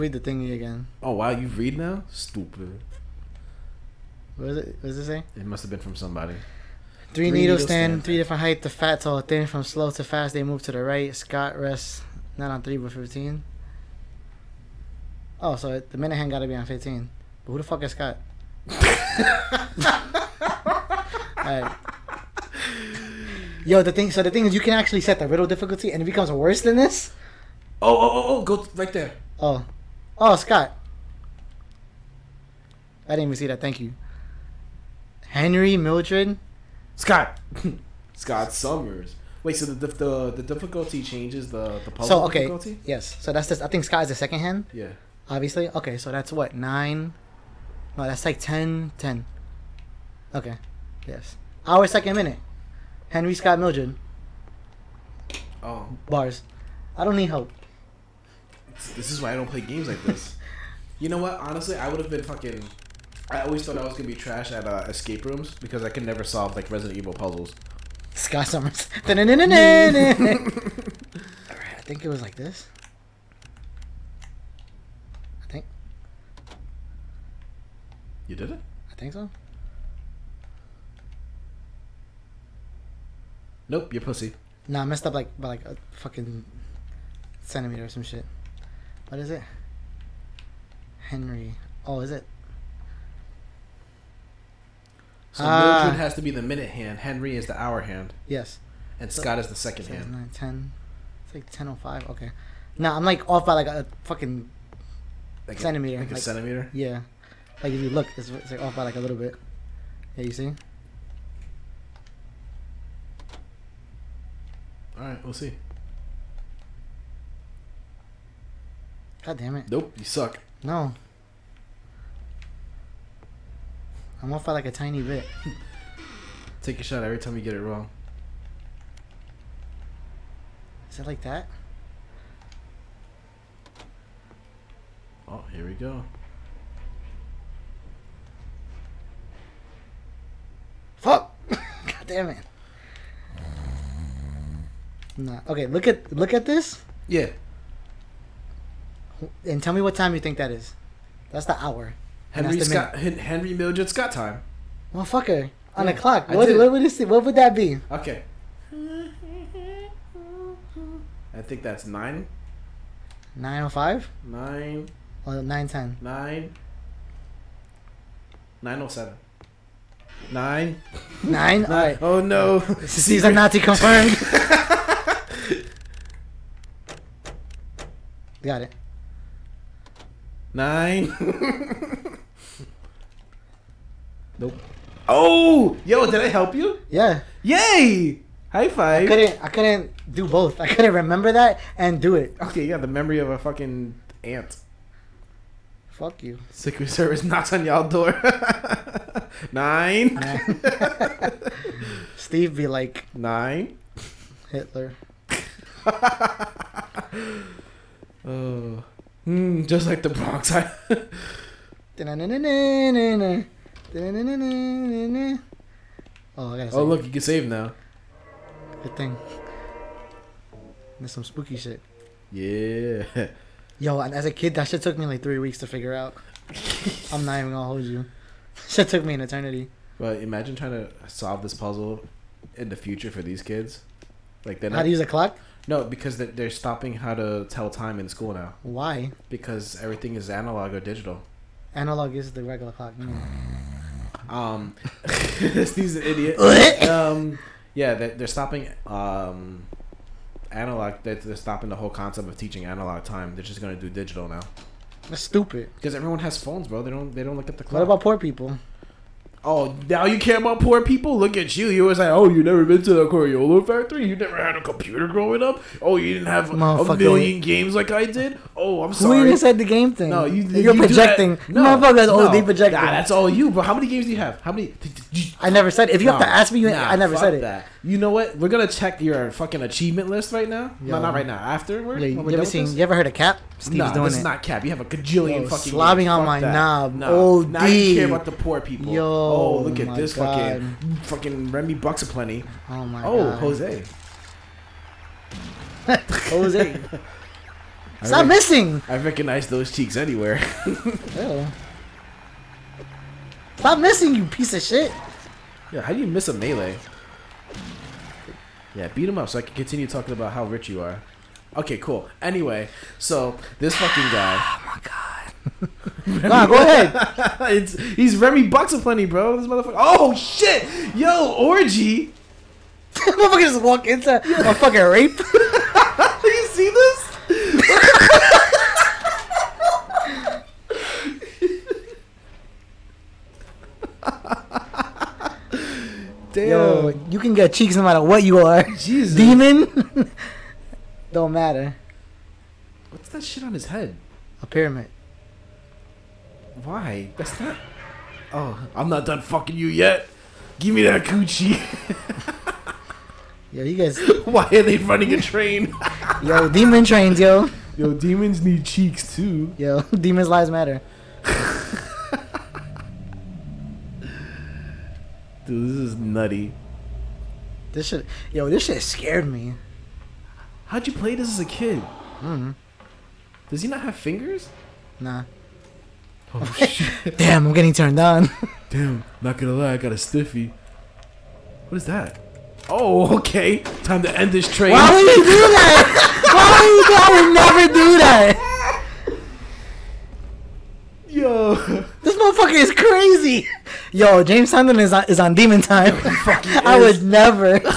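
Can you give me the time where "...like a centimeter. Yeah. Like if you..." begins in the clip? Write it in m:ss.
1:46.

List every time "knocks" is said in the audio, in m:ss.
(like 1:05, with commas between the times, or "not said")
3:17.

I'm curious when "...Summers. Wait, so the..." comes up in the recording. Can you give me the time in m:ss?
0:38.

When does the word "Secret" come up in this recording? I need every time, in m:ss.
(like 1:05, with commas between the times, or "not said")
3:16.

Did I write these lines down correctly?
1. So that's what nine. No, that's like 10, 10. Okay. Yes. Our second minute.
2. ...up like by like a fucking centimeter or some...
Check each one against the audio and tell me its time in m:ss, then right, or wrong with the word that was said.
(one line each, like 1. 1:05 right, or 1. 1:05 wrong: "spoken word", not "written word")
1. 0:45 right
2. 1:25 right.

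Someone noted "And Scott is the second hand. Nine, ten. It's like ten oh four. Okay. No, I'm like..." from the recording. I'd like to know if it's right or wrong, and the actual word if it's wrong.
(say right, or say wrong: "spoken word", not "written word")
wrong: "five", not "four".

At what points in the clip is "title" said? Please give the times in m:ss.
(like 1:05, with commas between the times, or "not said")
not said.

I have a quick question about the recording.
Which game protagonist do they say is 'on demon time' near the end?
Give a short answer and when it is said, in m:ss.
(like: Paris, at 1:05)
James Sunderland, at 6:34.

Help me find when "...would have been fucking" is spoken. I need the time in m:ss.
1:01.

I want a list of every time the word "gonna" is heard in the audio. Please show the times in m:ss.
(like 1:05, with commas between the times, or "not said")
1:03, 3:47, 4:13, 4:38, 6:19.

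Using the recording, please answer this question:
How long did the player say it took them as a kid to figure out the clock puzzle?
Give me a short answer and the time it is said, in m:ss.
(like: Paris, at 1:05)
3 weeks, at 3:45.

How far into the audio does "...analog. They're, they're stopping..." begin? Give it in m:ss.
4:10.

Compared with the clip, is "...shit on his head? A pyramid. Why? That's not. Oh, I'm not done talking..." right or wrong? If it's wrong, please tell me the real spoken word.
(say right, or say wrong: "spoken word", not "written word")
wrong: "fucking", not "talking".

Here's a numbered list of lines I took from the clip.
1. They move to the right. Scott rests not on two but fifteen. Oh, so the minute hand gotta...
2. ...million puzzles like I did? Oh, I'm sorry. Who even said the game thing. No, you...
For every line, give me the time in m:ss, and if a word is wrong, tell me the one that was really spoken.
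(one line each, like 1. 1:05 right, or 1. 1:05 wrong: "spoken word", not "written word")
1. 0:10 wrong: "three", not "two"
2. 4:26 wrong: "games", not "puzzles".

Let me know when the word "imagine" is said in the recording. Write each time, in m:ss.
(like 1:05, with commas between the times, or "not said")
3:50.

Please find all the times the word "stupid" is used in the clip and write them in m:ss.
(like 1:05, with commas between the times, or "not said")
0:02, 4:15.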